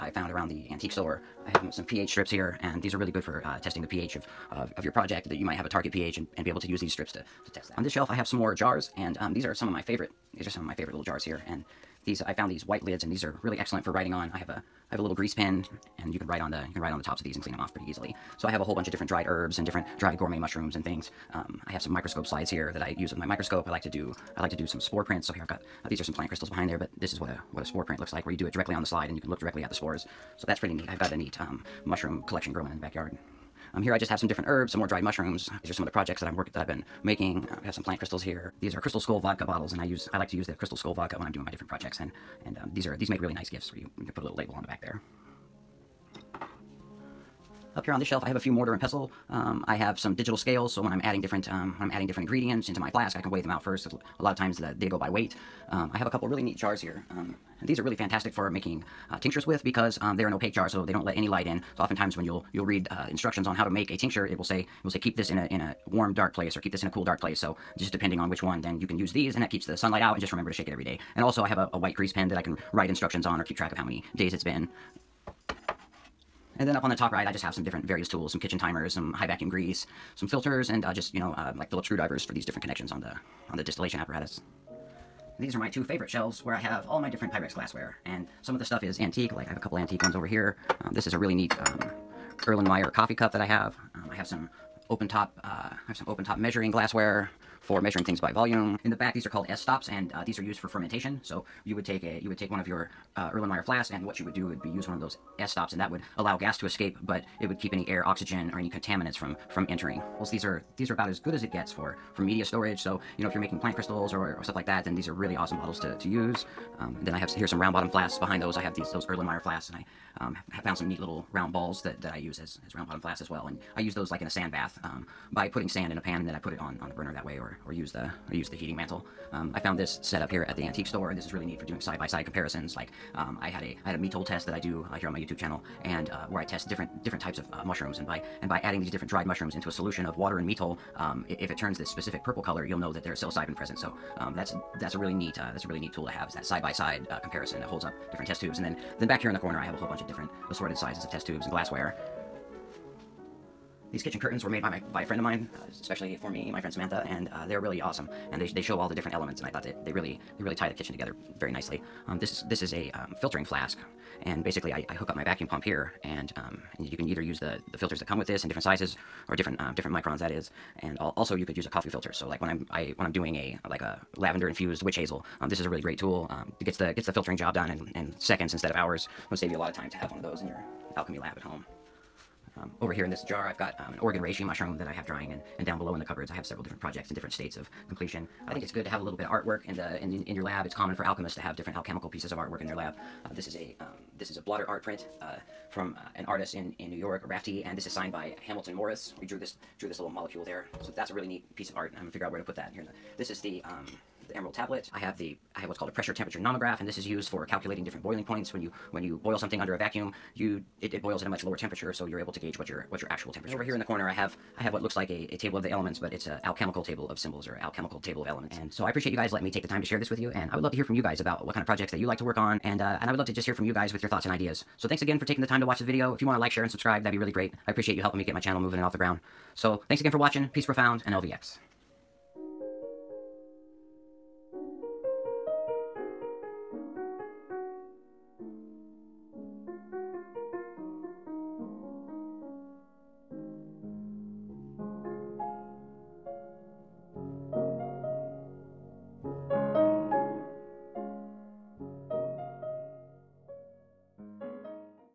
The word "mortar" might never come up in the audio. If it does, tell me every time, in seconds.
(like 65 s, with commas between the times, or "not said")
48 s.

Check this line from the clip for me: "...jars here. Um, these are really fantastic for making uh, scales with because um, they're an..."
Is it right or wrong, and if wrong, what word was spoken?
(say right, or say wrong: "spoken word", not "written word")
wrong: "tinctures", not "scales".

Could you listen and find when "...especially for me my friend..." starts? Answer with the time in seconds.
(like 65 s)
155 s.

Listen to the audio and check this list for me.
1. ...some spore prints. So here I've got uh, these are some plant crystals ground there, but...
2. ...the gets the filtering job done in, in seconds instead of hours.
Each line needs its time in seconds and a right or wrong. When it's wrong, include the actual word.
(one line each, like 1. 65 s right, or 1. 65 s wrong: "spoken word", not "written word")
1. 24 s wrong: "behind", not "ground"
2. 176 s right.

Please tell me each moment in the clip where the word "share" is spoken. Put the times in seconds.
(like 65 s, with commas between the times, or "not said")
219 s, 226 s.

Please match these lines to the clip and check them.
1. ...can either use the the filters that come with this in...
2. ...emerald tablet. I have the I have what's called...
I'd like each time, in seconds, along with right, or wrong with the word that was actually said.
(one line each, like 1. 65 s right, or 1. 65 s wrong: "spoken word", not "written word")
1. 166 s right
2. 204 s right.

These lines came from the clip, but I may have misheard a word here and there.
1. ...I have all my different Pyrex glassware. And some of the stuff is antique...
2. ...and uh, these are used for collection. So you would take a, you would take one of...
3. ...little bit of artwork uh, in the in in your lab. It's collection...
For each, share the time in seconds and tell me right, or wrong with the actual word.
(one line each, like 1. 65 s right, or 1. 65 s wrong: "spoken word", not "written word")
1. 86 s right
2. 99 s wrong: "fermentation", not "collection"
3. 189 s wrong: "common", not "collection".